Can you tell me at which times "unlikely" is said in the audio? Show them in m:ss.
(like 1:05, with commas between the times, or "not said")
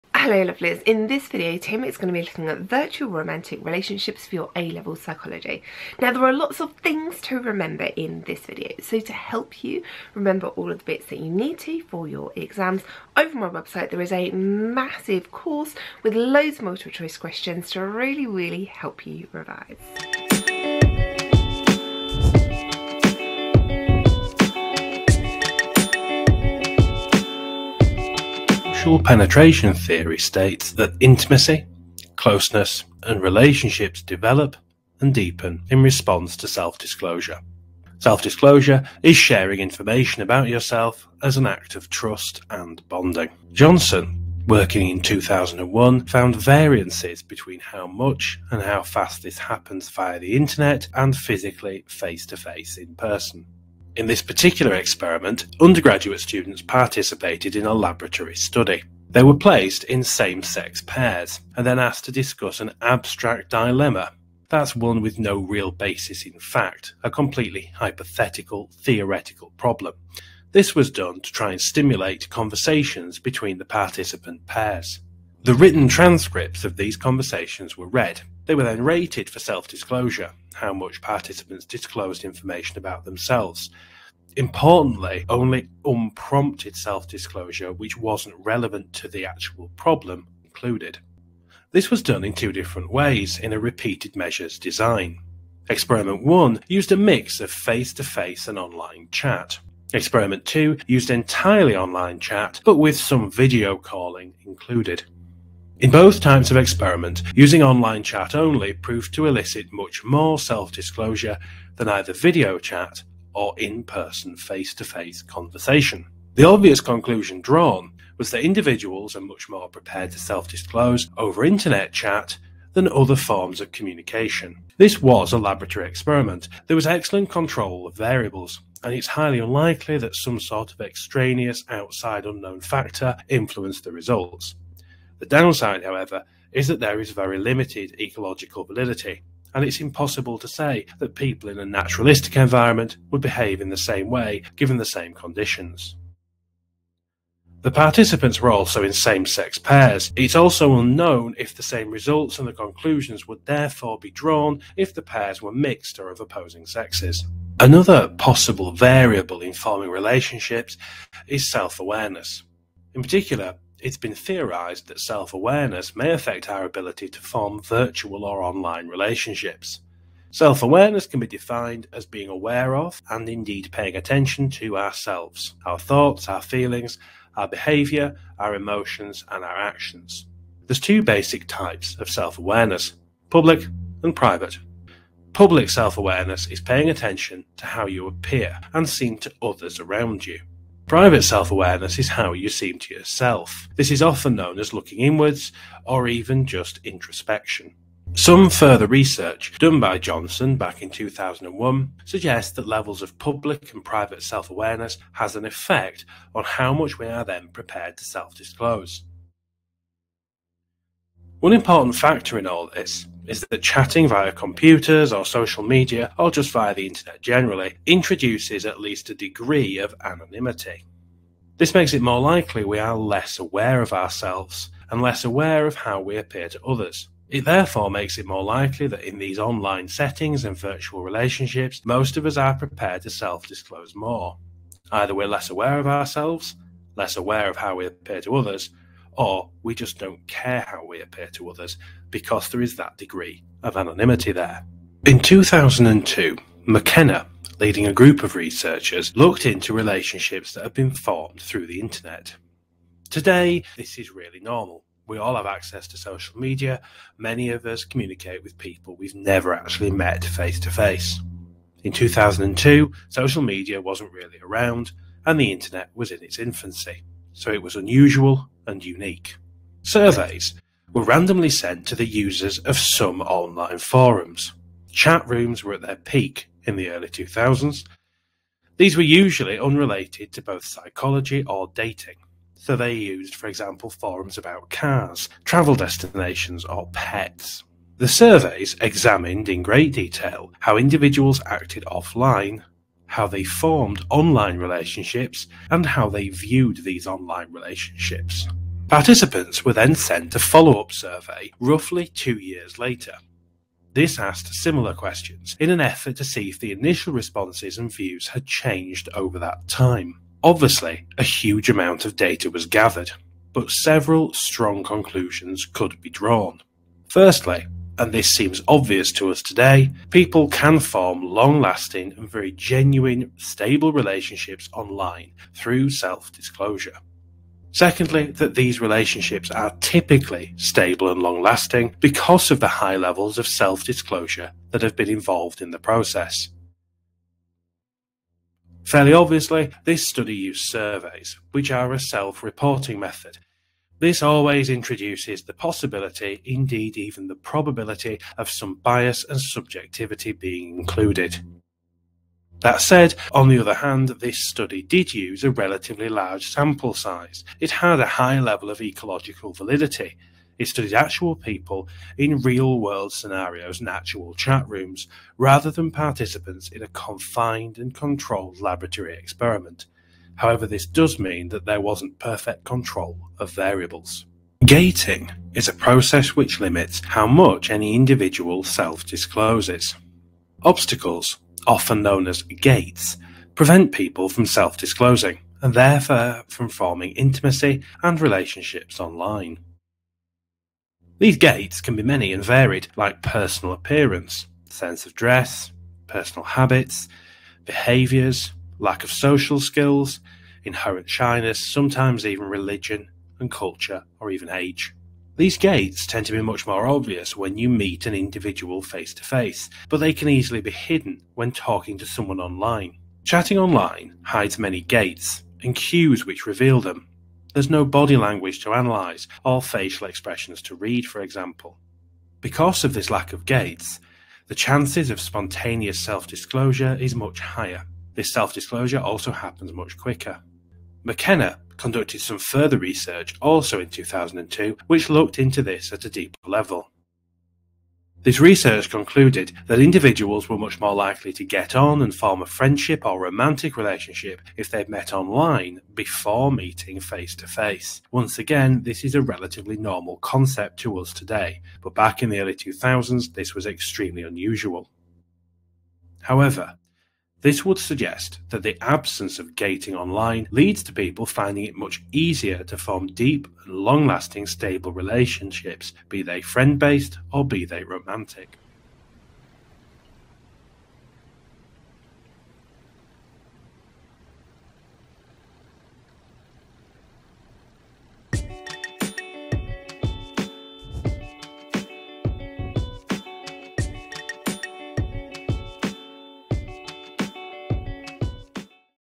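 2:09.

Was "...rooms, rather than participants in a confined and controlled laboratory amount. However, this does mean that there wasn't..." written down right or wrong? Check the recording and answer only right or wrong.
wrong.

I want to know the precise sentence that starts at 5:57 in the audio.
It had a high level of ecological validity.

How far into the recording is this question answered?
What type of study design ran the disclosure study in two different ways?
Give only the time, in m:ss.
1:33.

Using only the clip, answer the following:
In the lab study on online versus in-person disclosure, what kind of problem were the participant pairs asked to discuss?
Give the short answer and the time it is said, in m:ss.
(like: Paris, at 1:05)
An abstract dilemma, at 1:02.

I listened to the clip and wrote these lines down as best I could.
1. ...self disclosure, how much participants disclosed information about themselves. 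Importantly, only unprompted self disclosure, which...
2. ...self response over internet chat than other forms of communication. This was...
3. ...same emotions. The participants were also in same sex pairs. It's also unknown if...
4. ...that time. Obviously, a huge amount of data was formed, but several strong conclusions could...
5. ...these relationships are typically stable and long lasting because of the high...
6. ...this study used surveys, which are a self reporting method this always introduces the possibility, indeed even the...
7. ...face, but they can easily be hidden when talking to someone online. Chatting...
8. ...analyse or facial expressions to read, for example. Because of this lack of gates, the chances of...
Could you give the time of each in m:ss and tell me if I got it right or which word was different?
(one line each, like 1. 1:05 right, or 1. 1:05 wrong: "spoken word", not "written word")
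1. 1:19 right
2. 2:00 wrong: "disclose", not "response"
3. 2:24 wrong: "conditions", not "emotions"
4. 5:09 wrong: "gathered", not "formed"
5. 5:28 right
6. 5:39 right
7. 6:49 right
8. 6:58 right.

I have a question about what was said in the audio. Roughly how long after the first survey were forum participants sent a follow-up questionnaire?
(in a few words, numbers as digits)
2 years.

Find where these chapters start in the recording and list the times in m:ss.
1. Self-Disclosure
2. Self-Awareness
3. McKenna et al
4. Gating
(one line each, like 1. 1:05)
1. 0:29
2. 2:38
3. 4:05
4. 6:15.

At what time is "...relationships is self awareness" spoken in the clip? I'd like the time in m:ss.
2:39.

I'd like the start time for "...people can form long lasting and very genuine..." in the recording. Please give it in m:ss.
5:20.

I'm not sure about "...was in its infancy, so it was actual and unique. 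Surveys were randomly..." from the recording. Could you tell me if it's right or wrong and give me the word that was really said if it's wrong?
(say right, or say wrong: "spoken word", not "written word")
wrong: "unusual", not "actual".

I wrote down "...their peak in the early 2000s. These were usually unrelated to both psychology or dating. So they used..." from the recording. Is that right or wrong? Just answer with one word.
right.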